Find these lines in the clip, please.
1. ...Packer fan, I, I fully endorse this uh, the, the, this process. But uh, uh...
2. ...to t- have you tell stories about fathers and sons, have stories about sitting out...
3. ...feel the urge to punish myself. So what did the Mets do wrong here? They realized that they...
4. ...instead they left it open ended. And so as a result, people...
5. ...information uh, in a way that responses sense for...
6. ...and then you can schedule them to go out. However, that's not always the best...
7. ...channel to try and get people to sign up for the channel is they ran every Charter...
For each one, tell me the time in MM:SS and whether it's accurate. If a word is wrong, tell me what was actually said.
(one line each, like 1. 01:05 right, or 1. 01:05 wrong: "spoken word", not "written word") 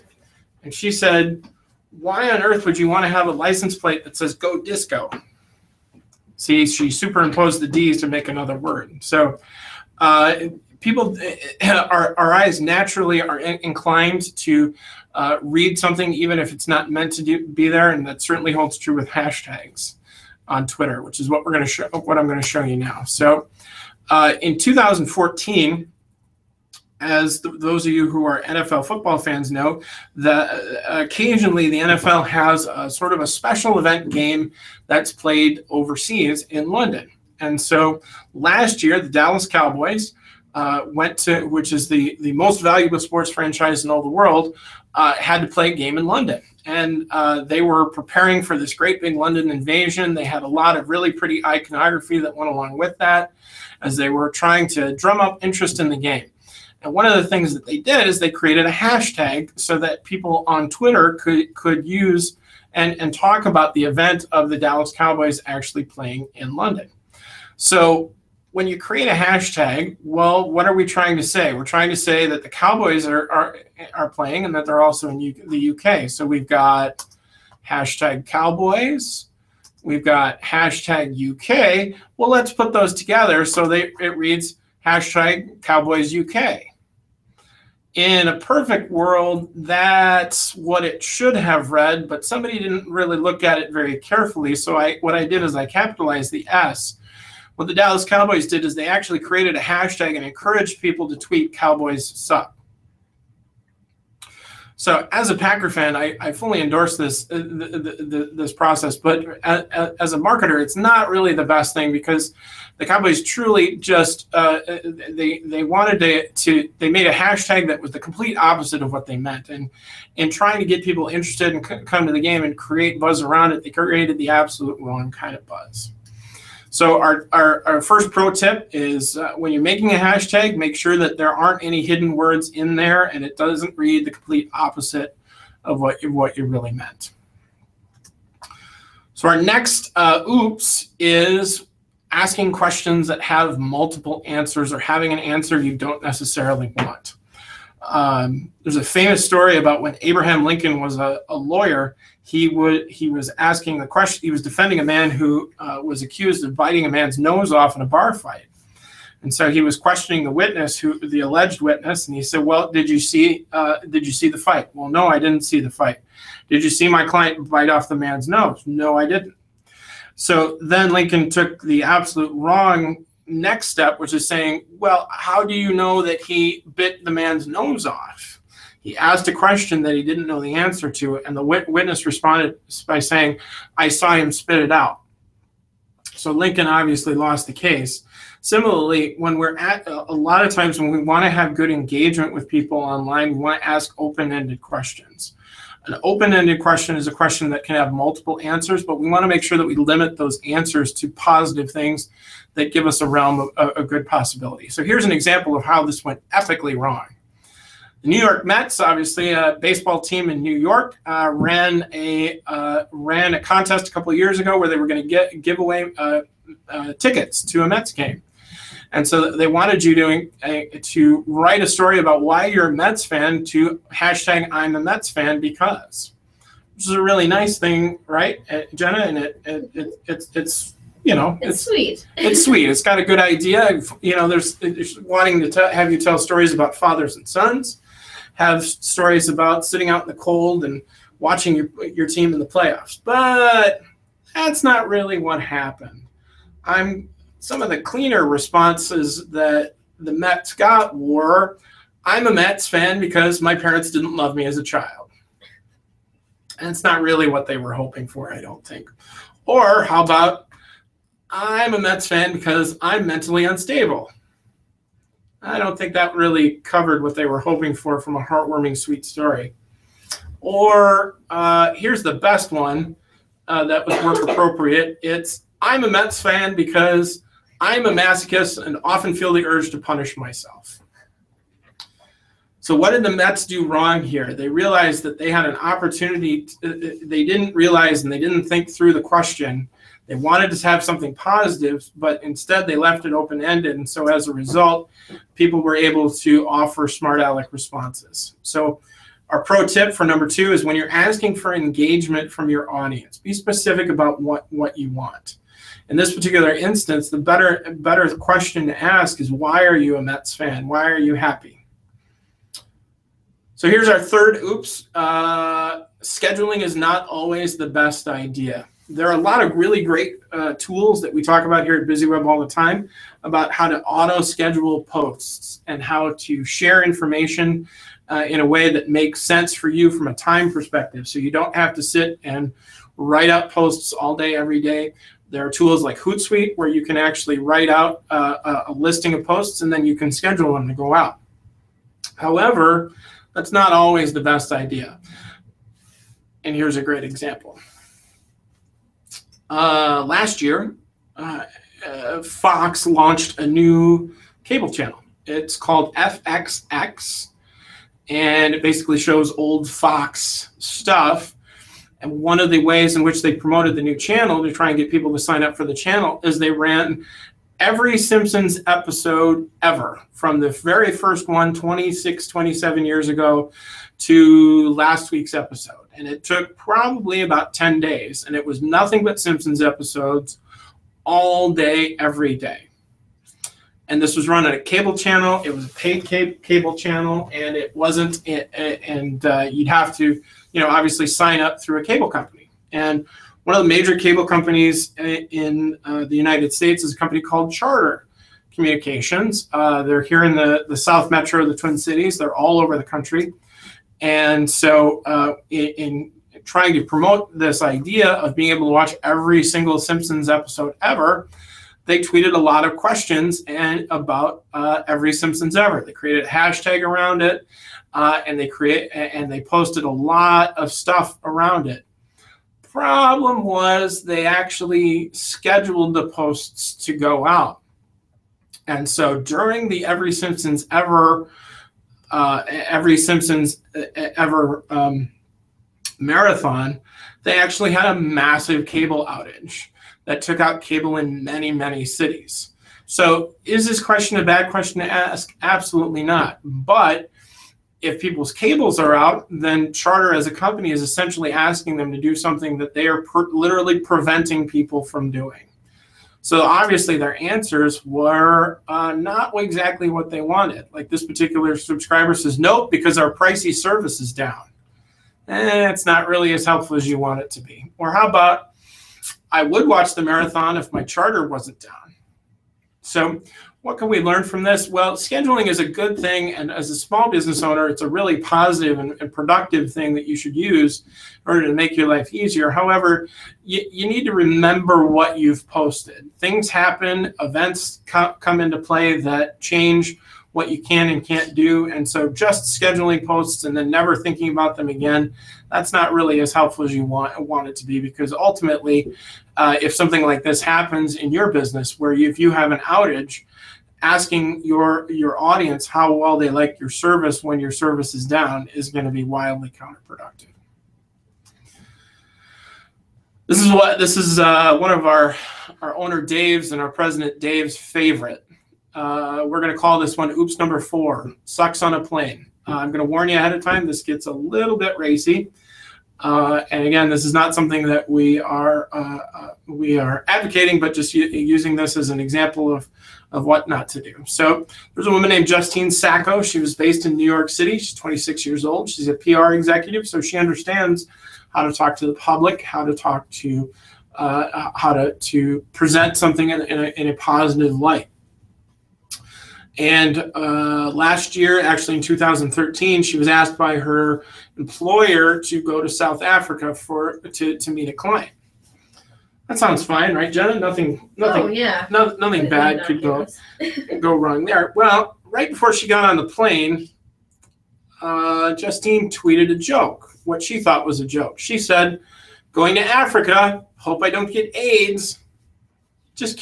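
1. 01:45 right
2. 03:55 right
3. 04:39 right
4. 04:52 right
5. 05:26 wrong: "makes", not "responses"
6. 05:39 right
7. 06:03 wrong: "Simpsons", not "Charter".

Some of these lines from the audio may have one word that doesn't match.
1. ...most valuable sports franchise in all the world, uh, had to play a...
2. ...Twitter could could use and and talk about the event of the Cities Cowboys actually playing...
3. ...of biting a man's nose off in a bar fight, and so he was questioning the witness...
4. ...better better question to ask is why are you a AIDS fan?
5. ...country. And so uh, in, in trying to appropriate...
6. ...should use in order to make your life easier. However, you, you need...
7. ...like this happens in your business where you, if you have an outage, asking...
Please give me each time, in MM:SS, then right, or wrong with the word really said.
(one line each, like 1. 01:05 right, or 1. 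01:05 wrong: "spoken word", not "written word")
1. 00:42 right
2. 01:00 wrong: "Dallas", not "Cities"
3. 02:36 right
4. 05:07 wrong: "Mets", not "AIDS"
5. 06:42 wrong: "promote", not "appropriate"
6. 08:00 right
7. 08:20 right.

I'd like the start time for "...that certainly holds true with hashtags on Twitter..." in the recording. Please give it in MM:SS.
00:18.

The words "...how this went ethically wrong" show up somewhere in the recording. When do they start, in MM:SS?
03:25.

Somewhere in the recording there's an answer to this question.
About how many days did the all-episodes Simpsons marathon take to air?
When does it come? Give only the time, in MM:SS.
06:17.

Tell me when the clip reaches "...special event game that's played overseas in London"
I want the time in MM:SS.
00:33.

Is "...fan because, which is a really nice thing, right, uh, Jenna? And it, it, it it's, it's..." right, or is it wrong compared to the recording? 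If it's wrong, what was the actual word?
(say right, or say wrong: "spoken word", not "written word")
right.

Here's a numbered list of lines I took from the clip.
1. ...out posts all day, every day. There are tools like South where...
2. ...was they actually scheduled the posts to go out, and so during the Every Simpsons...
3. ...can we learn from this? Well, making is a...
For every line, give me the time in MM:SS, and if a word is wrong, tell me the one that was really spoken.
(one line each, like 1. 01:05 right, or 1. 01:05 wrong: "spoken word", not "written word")
1. 05:33 wrong: "Hootsuite", not "South"
2. 07:03 right
3. 07:53 wrong: "scheduling", not "making".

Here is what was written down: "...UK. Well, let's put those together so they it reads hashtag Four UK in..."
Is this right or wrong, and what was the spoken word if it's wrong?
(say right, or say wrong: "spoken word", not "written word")
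wrong: "Cowboys", not "Four".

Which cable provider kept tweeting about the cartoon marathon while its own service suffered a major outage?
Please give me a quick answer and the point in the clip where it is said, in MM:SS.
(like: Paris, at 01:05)
Charter Communications, at 06:37.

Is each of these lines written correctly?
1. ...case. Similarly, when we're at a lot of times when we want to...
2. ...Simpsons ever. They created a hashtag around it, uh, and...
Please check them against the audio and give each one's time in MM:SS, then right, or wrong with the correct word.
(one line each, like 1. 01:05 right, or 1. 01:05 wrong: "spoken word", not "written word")
1. 03:07 right
2. 06:55 right.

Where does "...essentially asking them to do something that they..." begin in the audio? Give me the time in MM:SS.
07:30.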